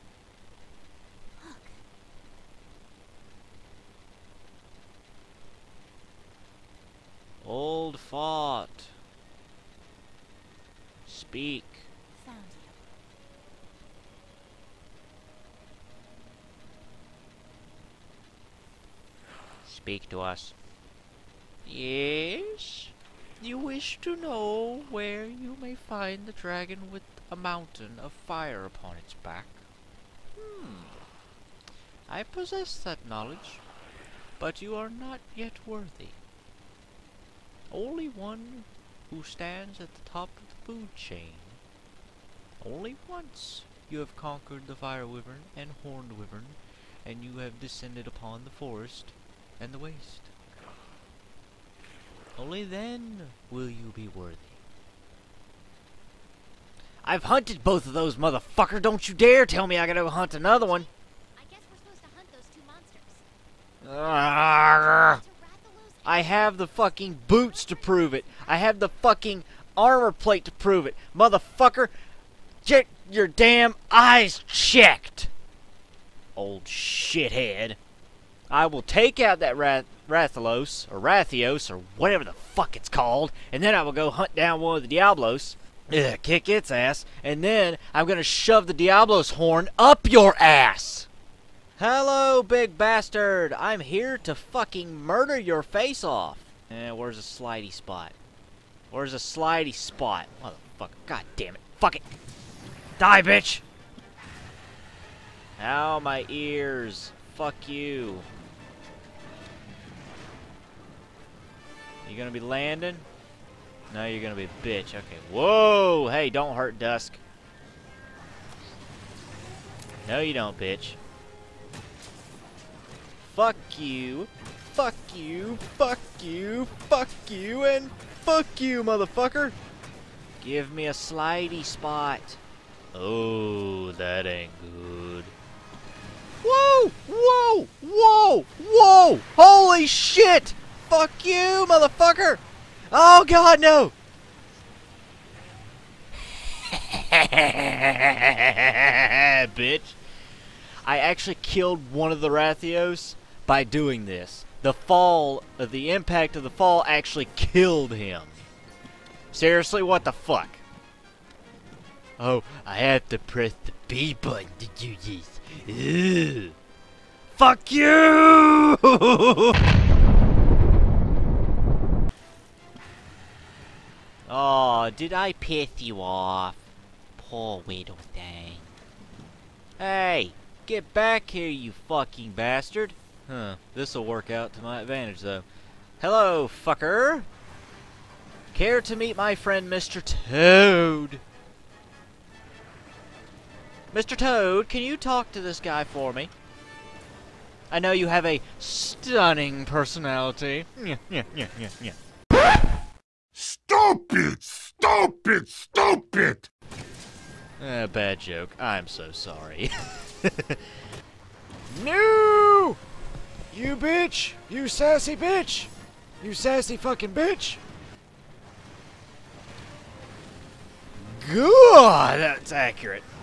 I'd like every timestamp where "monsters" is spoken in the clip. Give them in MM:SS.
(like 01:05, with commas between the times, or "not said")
01:03.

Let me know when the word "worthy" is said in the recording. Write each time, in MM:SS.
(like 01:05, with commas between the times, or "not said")
00:35, 00:54.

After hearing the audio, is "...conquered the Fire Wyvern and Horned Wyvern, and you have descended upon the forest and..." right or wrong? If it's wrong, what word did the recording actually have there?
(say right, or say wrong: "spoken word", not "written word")
right.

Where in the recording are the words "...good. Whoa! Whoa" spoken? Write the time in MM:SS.
02:14.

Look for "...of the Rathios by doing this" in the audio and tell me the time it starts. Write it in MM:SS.
02:32.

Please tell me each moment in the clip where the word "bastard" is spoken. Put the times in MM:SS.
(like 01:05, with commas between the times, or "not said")
01:32, 03:02.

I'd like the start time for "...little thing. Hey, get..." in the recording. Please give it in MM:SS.
02:57.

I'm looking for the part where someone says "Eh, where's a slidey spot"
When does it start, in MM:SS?
01:36.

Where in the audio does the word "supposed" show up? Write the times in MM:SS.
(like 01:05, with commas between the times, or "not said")
01:01.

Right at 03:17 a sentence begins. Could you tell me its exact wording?
I know you have a stunning personality.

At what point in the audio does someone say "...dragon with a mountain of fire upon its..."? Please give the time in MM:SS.
00:26.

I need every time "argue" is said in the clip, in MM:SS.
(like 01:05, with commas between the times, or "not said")
not said.